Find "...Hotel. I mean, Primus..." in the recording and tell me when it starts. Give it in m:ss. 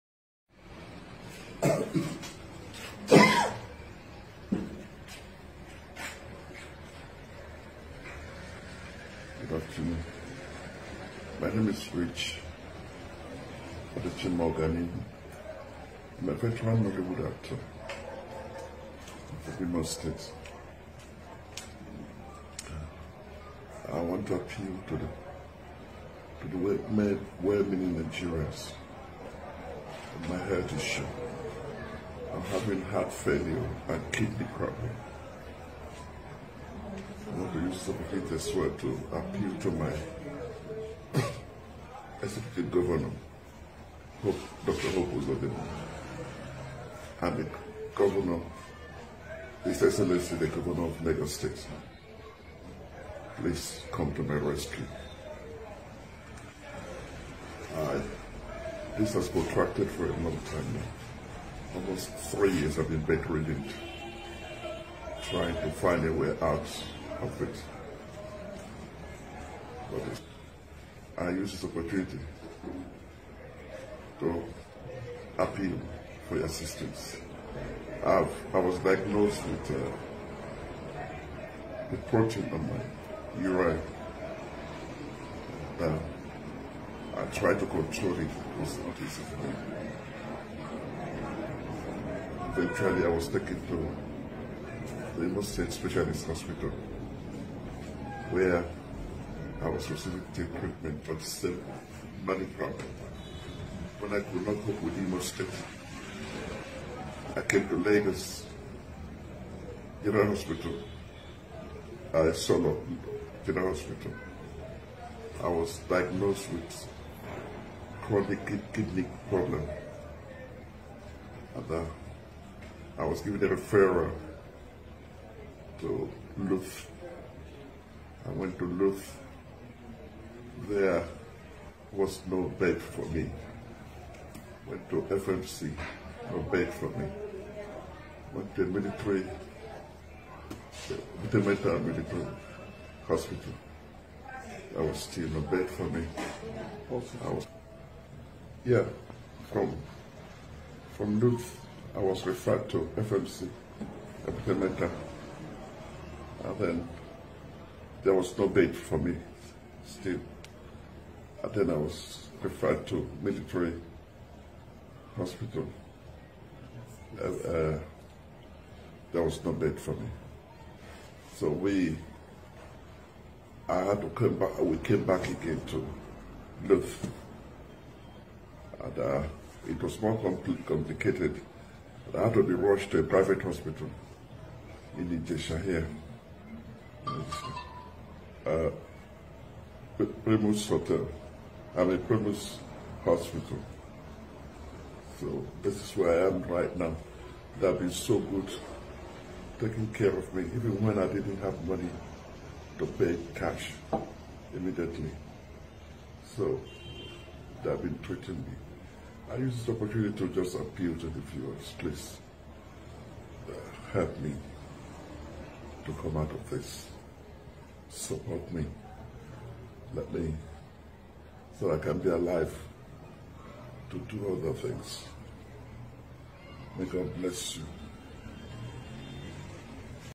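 3:10.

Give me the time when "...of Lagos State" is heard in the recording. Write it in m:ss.
0:50.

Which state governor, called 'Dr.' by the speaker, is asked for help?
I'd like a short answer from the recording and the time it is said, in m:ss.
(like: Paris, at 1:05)
Hope Uzodimma, at 0:44.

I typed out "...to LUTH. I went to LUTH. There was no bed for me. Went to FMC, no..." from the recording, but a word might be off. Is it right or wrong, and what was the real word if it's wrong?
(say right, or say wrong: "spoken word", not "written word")
right.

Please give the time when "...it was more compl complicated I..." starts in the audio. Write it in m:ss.
2:59.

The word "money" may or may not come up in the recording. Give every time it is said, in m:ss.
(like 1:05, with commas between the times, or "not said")
1:42, 3:21.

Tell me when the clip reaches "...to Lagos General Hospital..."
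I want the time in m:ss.
1:47.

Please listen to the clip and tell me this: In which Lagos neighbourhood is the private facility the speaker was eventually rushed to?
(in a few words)
Ijesha.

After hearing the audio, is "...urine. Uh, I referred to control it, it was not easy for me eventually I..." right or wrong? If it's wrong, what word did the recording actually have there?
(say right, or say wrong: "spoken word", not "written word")
wrong: "tried", not "referred".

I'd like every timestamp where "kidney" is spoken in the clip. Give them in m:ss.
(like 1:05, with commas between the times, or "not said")
0:34, 1:58.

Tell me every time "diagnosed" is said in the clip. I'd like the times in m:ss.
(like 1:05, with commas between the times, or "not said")
1:18, 1:55.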